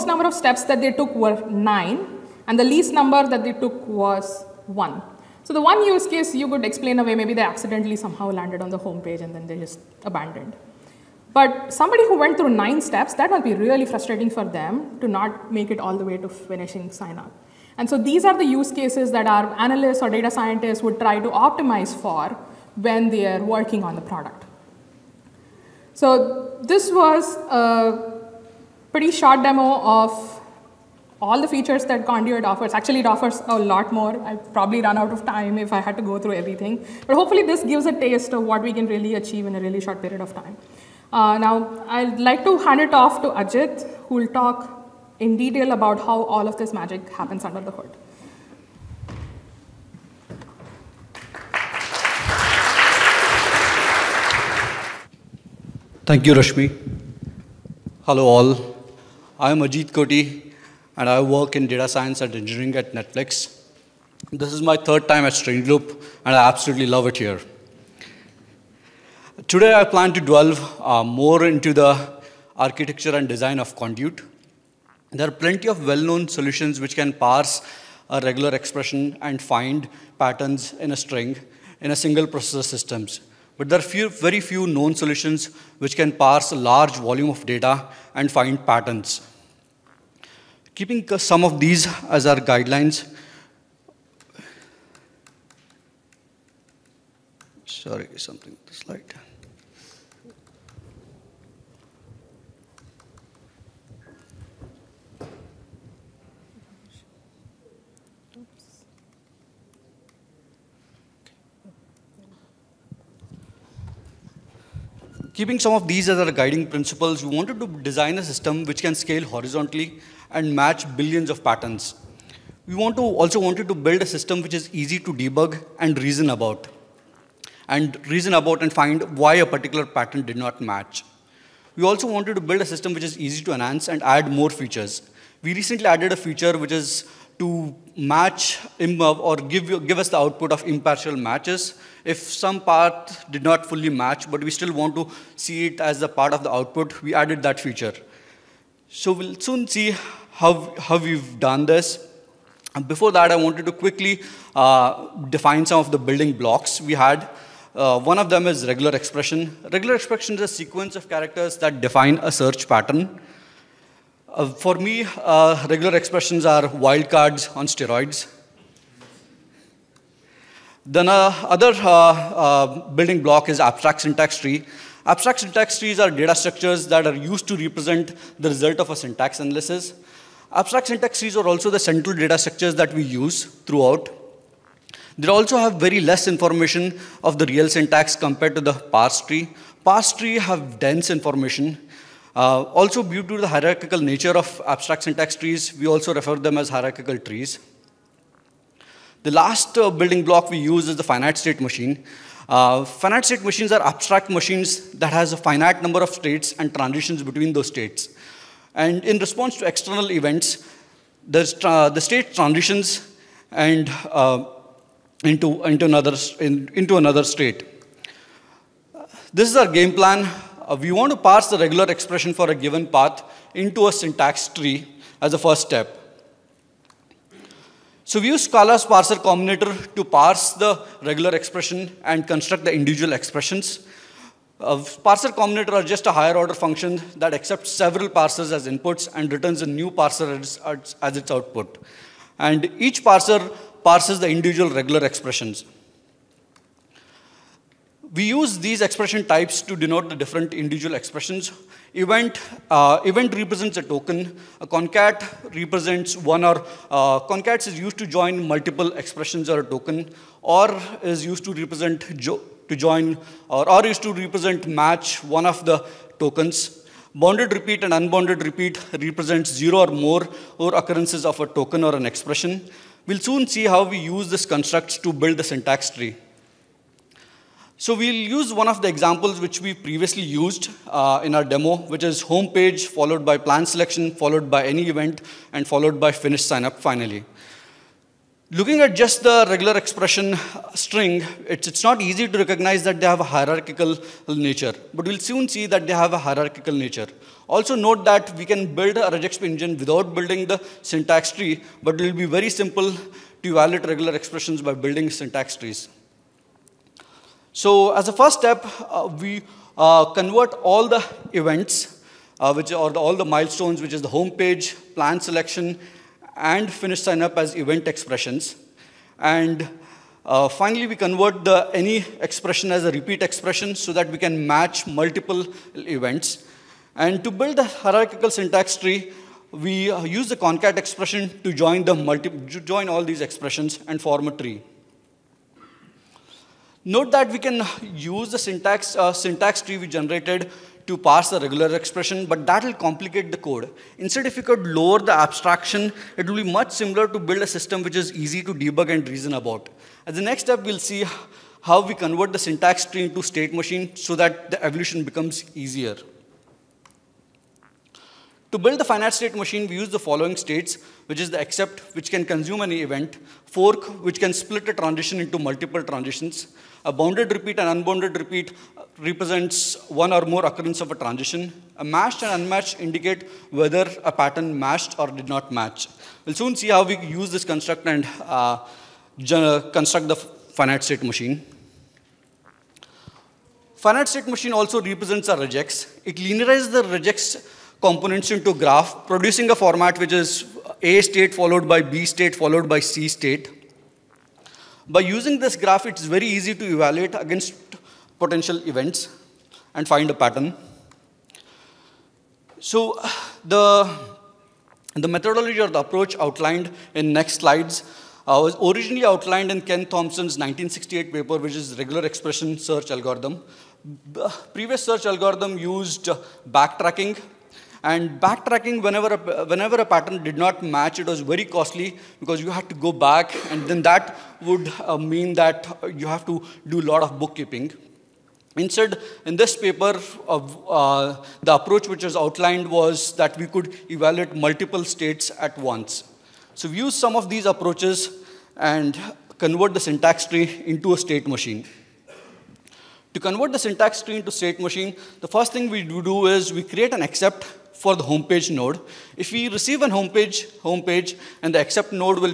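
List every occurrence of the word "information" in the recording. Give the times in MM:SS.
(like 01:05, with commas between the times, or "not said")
03:06, 03:11.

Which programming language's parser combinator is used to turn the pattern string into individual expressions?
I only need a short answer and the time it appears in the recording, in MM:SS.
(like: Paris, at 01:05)
Scala, at 03:48.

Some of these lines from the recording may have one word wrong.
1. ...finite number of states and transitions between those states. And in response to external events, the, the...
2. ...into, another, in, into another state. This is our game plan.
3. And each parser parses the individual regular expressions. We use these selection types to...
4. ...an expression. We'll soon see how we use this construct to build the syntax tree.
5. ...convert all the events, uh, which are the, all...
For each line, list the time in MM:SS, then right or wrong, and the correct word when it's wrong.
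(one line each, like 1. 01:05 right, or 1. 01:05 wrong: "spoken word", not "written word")
1. 03:25 right
2. 03:35 right
3. 04:02 wrong: "expression", not "selection"
4. 04:31 right
5. 05:10 right.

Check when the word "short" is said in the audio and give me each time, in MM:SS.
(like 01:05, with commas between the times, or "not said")
00:29, 00:39.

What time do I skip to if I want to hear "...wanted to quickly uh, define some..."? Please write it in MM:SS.
02:33.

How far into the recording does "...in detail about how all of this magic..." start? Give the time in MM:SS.
00:45.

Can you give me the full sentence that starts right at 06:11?
A matched and unmatched indicate whether a pattern matched or did not match.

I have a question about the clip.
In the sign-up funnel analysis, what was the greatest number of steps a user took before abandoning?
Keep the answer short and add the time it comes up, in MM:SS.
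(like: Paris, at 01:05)
9, at 00:01.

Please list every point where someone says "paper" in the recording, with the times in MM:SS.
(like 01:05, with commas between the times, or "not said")
06:51, 07:09.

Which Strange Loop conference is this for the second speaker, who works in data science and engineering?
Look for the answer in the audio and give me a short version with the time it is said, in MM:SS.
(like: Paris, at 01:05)
third, at 01:04.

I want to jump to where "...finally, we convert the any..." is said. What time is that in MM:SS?
05:20.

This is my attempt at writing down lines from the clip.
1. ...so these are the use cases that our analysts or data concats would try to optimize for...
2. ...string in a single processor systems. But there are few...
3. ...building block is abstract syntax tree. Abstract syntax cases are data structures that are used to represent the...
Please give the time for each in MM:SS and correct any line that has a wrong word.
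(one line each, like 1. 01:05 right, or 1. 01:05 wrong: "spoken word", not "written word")
1. 00:17 wrong: "scientists", not "concats"
2. 01:20 right
3. 02:52 wrong: "trees", not "cases".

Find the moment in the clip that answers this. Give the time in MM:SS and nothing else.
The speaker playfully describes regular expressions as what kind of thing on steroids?
02:46.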